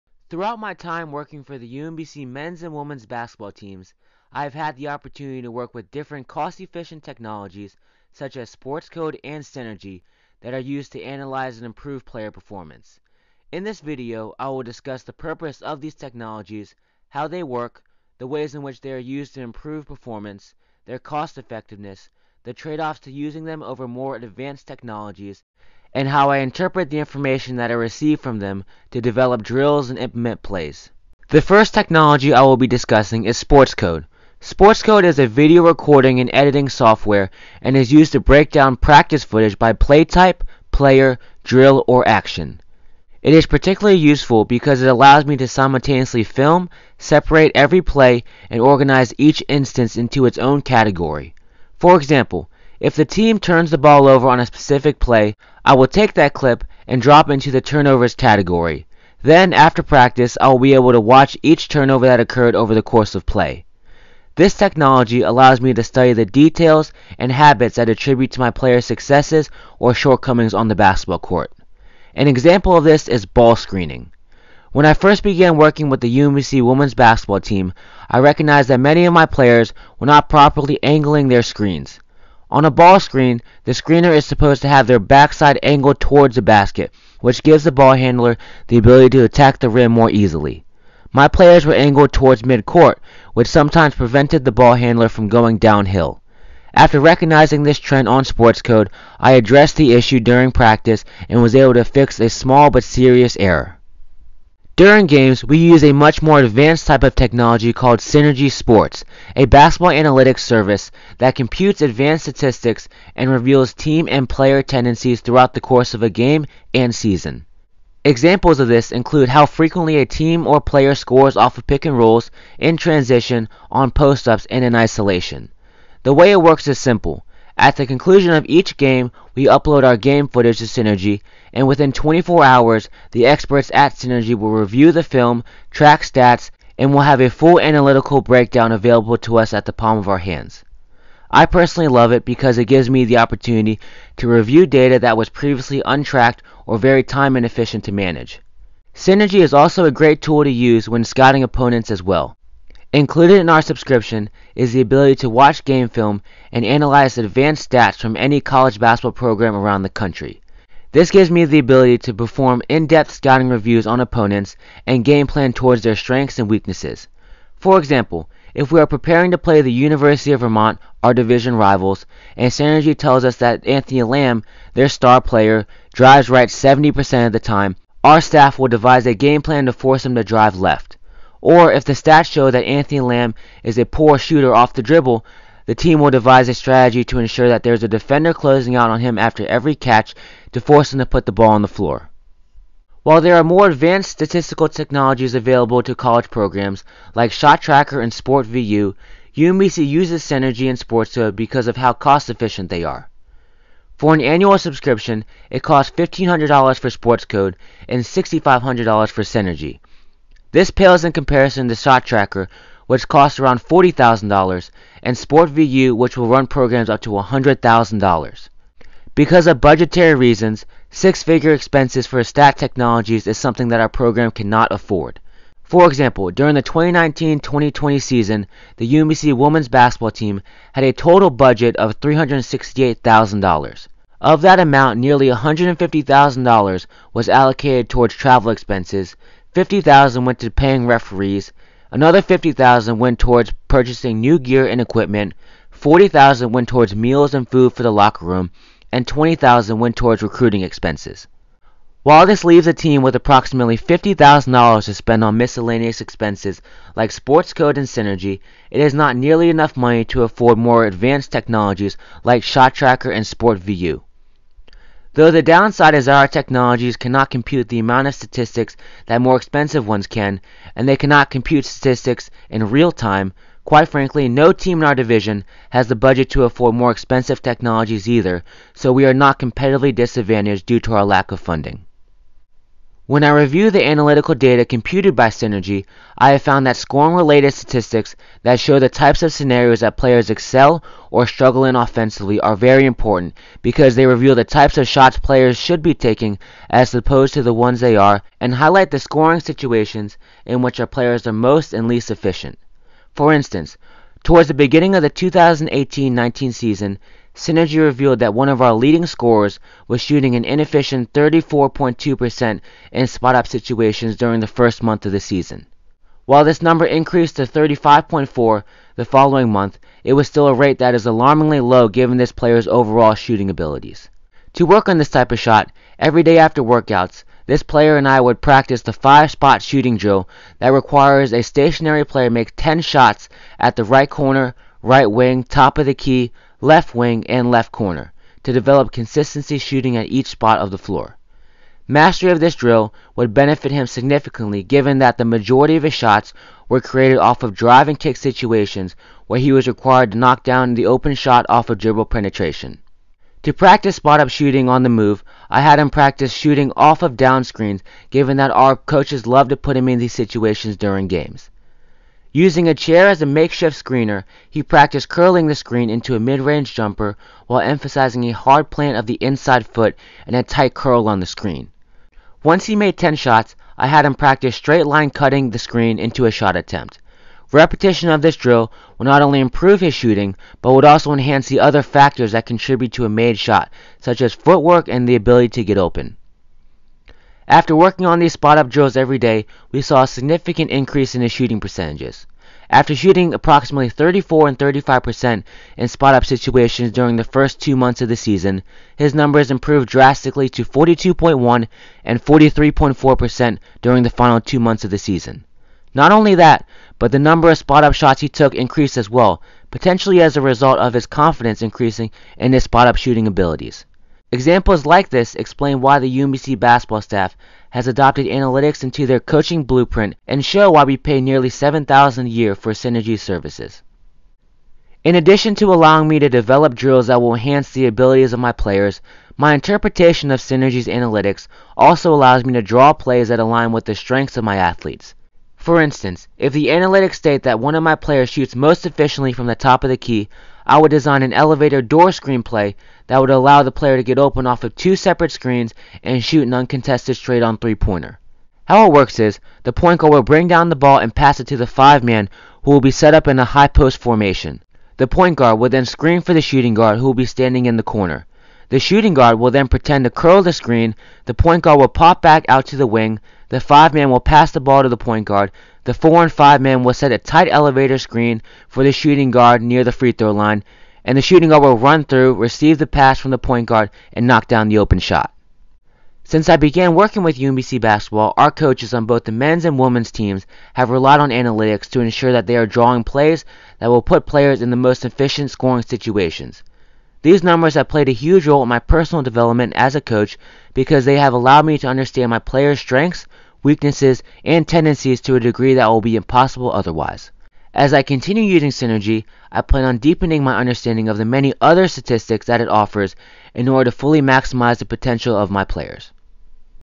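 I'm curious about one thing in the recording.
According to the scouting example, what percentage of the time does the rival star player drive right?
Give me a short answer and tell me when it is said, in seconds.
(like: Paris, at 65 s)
70%, at 176 s.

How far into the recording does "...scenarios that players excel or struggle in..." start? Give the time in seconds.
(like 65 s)
289 s.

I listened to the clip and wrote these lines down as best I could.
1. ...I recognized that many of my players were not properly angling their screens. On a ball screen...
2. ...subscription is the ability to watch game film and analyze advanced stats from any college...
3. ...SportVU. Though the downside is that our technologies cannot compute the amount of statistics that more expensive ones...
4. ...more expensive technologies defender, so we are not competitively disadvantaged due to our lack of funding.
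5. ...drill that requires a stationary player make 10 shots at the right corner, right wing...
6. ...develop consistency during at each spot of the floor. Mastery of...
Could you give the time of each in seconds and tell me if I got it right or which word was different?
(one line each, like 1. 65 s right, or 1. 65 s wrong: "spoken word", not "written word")
1. 78 s right
2. 153 s right
3. 263 s right
4. 276 s wrong: "either", not "defender"
5. 329 s right
6. 338 s wrong: "shooting", not "during".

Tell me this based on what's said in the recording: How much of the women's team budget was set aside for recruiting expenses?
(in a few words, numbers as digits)
$20,000.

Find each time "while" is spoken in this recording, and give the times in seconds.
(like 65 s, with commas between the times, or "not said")
193 s, 252 s, 316 s, 367 s.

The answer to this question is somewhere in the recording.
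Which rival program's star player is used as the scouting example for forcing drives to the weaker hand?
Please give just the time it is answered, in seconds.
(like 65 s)
169 s.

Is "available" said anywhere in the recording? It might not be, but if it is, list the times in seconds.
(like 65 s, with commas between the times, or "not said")
138 s, 195 s.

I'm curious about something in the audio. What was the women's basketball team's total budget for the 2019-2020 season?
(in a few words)
$368,000.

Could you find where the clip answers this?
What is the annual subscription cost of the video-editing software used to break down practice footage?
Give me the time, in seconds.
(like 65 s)
205 s.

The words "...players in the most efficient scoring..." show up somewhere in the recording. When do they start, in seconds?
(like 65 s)
484 s.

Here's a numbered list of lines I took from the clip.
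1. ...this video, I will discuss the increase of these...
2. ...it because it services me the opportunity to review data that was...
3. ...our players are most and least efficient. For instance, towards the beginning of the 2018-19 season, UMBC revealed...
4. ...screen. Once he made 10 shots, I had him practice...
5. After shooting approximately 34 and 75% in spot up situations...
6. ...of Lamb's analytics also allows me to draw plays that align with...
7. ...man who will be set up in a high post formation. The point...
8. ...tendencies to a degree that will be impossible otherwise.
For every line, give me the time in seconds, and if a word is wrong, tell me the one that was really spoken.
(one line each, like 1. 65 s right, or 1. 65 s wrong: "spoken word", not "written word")
1. 13 s wrong: "purpose", not "increase"
2. 142 s wrong: "gives", not "services"
3. 300 s wrong: "Synergy", not "UMBC"
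4. 371 s right
5. 392 s wrong: "35", not "75"
6. 430 s wrong: "Synergy", not "Lamb"
7. 452 s right
8. 494 s right.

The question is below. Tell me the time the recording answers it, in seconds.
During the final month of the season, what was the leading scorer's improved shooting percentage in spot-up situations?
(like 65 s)
402 s.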